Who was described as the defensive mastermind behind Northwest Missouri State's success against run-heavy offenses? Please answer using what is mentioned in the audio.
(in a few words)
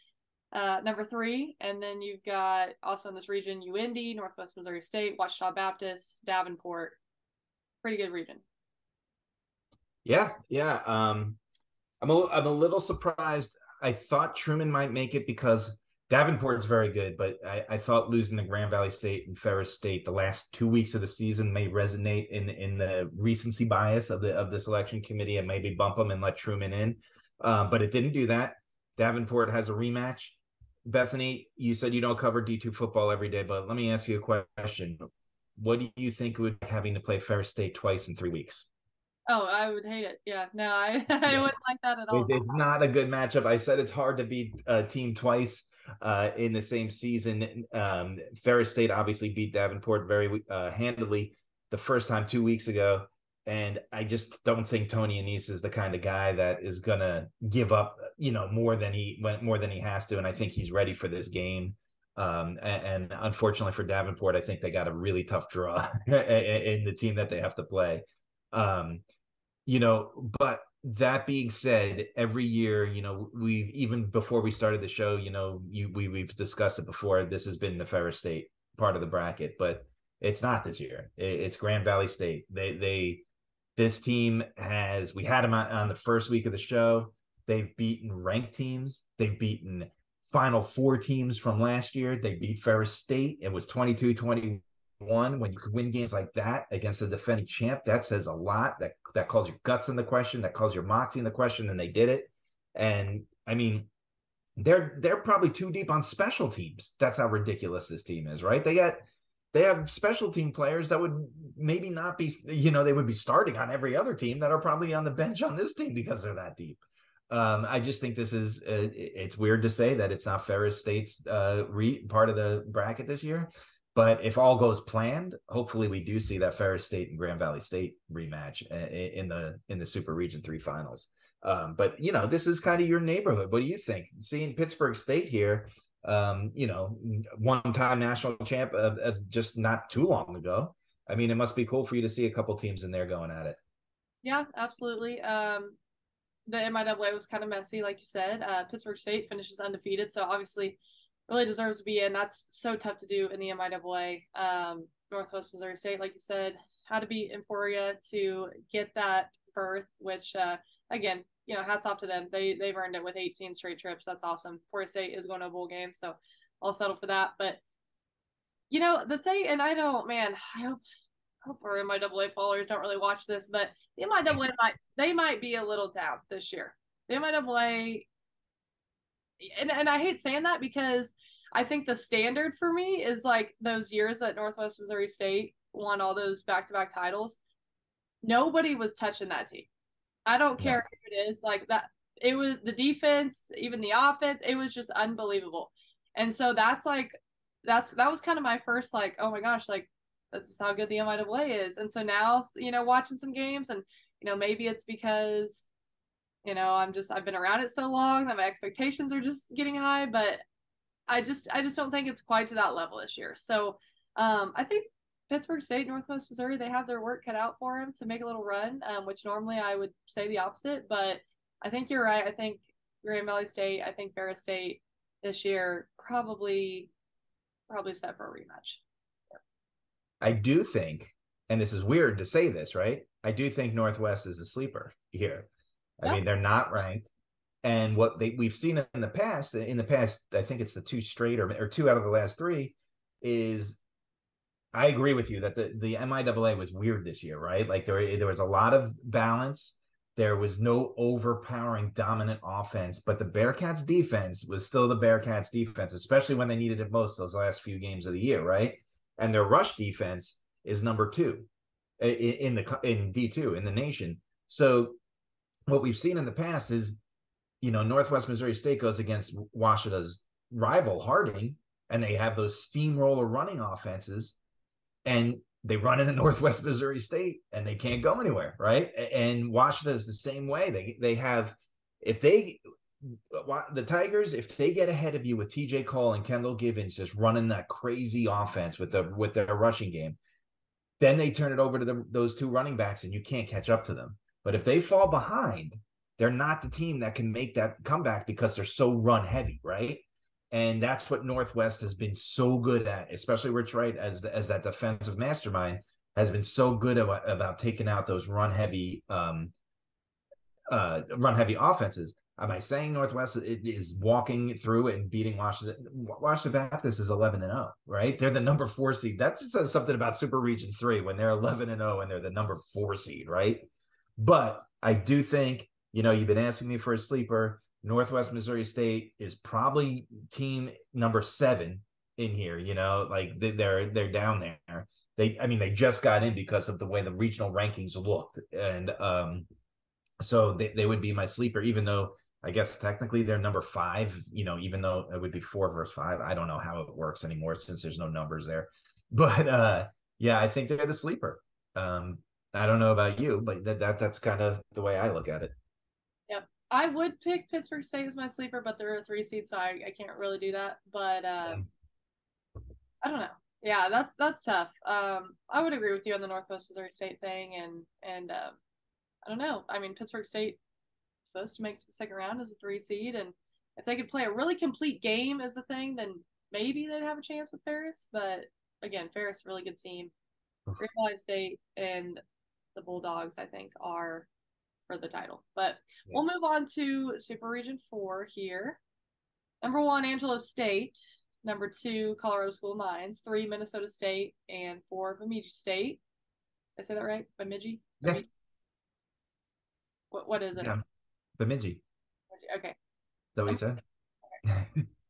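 Rich Wright.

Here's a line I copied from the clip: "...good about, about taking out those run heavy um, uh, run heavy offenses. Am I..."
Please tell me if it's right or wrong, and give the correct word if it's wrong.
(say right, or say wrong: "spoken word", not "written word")
right.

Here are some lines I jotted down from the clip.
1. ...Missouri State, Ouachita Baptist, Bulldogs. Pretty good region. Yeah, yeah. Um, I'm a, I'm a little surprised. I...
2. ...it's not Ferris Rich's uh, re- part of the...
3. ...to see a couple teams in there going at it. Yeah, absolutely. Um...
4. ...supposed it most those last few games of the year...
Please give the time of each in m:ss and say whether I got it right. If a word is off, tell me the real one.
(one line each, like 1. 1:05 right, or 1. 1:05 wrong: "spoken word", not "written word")
1. 0:04 wrong: "Davenport", not "Bulldogs"
2. 2:00 wrong: "State", not "Rich"
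3. 2:22 right
4. 4:16 wrong: "needed", not "supposed".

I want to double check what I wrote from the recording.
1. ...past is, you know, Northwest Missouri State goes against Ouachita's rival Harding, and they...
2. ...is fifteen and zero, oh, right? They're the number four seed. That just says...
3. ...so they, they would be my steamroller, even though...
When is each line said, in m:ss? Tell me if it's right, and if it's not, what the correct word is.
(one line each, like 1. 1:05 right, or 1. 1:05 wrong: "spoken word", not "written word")
1. 4:26 right
2. 5:16 wrong: "eleven", not "fifteen"
3. 5:40 wrong: "sleeper", not "steamroller".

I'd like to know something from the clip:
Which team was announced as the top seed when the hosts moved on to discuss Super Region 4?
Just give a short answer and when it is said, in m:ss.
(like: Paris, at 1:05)
Angelo State, at 6:30.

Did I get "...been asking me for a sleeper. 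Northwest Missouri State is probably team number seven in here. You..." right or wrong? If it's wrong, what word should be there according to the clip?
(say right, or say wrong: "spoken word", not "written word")
right.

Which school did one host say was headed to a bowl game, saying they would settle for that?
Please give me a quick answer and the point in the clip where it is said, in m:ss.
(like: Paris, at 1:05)
Forest State, at 2:44.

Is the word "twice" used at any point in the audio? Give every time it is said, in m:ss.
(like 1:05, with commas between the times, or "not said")
0:37, 0:45.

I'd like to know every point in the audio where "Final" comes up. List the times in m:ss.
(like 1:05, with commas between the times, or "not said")
1:30, 2:10.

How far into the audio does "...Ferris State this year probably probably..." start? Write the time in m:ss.
3:44.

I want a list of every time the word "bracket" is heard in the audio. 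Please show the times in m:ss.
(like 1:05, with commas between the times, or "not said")
1:19, 2:02.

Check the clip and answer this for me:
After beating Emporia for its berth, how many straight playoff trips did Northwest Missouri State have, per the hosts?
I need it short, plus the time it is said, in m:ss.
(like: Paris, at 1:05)
18, at 2:43.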